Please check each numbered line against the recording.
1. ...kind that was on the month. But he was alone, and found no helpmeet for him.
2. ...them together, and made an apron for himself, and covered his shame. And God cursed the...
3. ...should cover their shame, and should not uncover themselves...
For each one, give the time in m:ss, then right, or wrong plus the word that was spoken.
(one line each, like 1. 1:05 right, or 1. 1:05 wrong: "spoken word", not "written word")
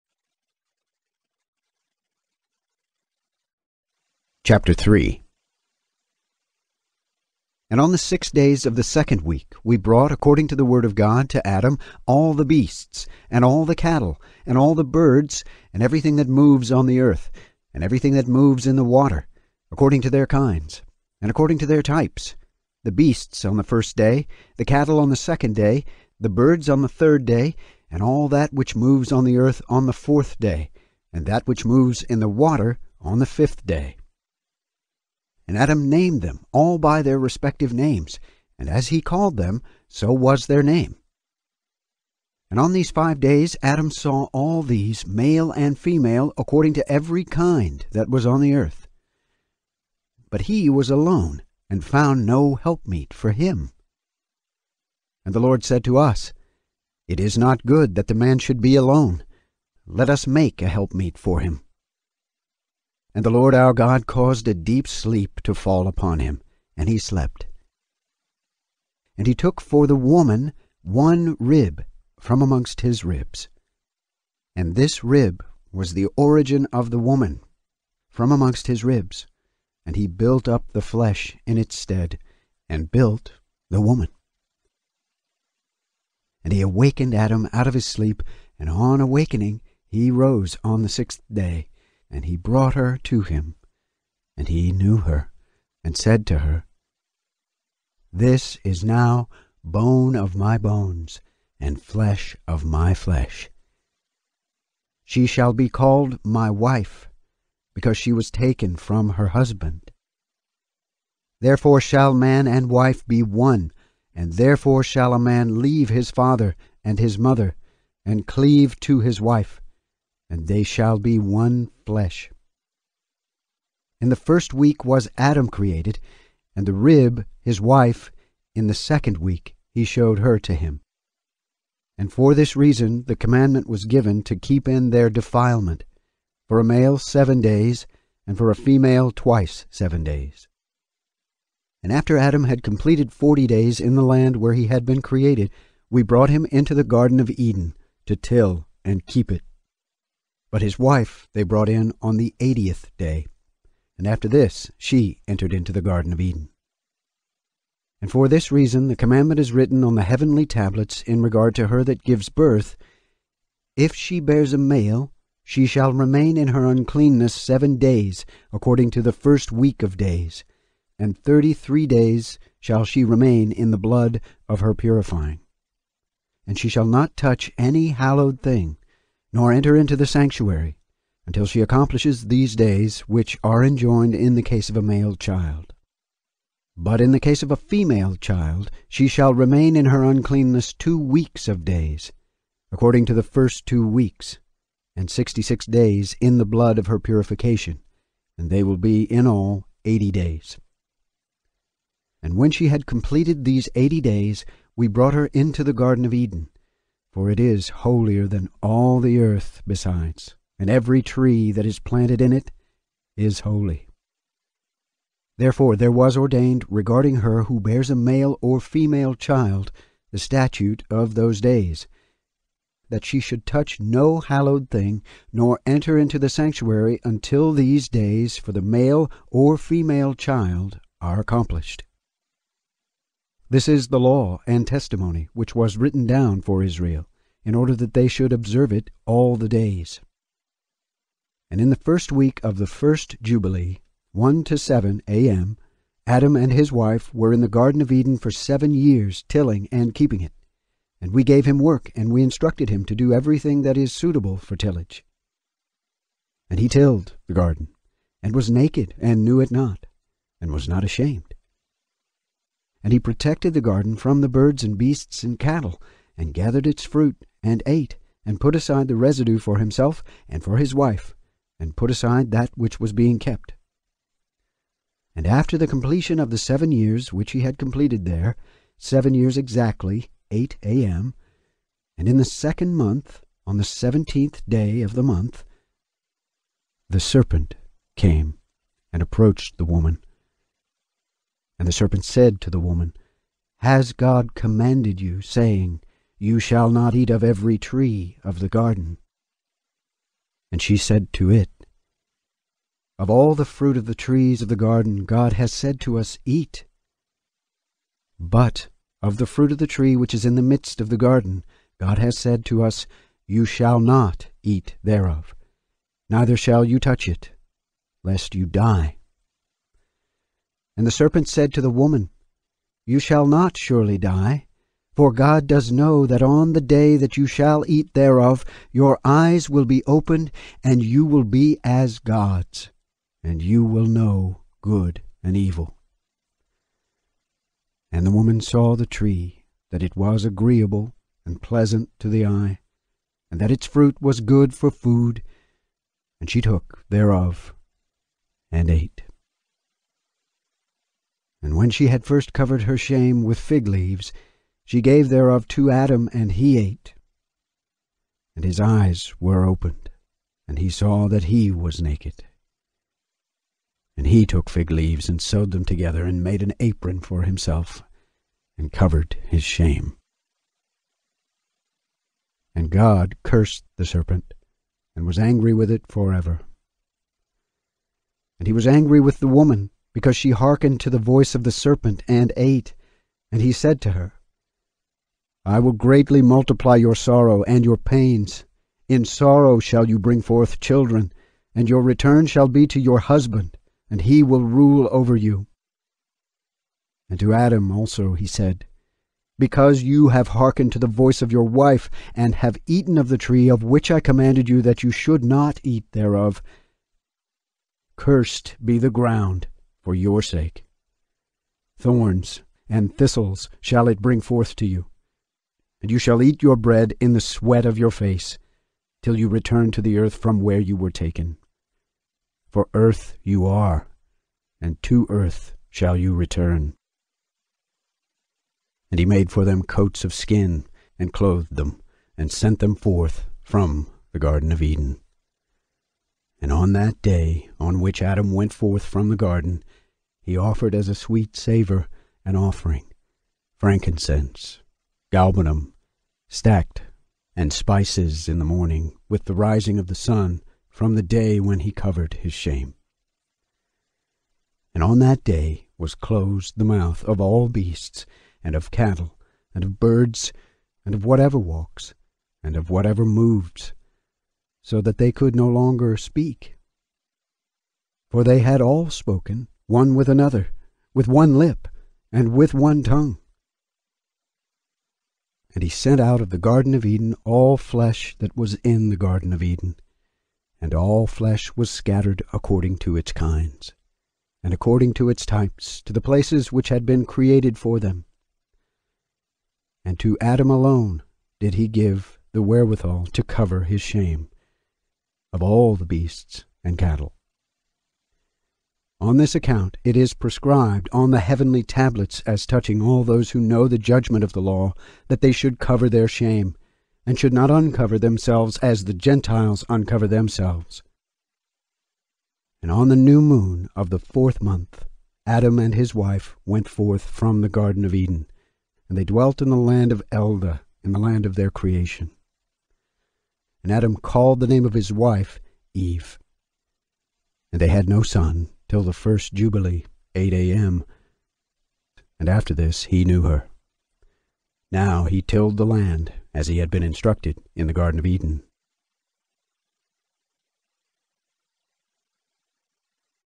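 1. 0:47 wrong: "earth", not "month"
2. 6:05 right
3. 8:25 right.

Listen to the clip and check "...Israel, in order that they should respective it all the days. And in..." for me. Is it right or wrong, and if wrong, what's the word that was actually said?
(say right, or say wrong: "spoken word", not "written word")
wrong: "observe", not "respective".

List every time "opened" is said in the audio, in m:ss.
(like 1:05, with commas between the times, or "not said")
5:29, 5:59.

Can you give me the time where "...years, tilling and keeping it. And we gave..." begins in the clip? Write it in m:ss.
4:08.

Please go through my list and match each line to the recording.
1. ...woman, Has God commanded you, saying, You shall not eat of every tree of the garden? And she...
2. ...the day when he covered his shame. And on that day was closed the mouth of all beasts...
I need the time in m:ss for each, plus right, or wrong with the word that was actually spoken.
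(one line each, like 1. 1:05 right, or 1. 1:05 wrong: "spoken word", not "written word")
1. 4:52 right
2. 7:30 right.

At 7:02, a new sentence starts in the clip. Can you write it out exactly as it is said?
For earth you are, and to earth shall you return.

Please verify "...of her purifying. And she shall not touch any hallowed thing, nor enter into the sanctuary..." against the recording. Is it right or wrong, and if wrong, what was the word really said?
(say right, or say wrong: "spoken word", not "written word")
right.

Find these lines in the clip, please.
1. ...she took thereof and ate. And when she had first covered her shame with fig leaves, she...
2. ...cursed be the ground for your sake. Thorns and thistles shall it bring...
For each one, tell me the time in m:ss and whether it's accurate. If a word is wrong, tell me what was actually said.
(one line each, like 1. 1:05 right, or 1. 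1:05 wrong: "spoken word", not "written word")
1. 5:46 right
2. 6:47 right.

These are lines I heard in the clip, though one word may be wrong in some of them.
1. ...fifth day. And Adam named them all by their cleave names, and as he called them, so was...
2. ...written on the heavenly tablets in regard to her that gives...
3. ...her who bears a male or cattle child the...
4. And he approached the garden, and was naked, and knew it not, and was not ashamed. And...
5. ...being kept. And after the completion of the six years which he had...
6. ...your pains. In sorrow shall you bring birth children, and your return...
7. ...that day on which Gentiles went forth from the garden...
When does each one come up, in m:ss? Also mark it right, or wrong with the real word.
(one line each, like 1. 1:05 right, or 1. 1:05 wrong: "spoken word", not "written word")
1. 0:33 wrong: "respective", not "cleave"
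2. 2:39 right
3. 3:37 wrong: "female", not "cattle"
4. 4:16 wrong: "tilled", not "approached"
5. 4:32 wrong: "seven", not "six"
6. 6:27 wrong: "forth", not "birth"
7. 7:16 wrong: "Adam", not "Gentiles".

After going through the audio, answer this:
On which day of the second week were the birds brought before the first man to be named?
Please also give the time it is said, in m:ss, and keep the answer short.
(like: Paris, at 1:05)
third day, at 0:26.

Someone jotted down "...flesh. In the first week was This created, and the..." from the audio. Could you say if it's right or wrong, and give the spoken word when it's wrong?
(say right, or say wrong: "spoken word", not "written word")
wrong: "Adam", not "This".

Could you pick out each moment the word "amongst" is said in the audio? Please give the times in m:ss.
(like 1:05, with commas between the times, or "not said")
1:12, 1:18.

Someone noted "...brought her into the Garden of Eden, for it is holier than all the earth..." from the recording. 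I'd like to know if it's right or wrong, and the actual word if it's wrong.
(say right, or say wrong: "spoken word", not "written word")
right.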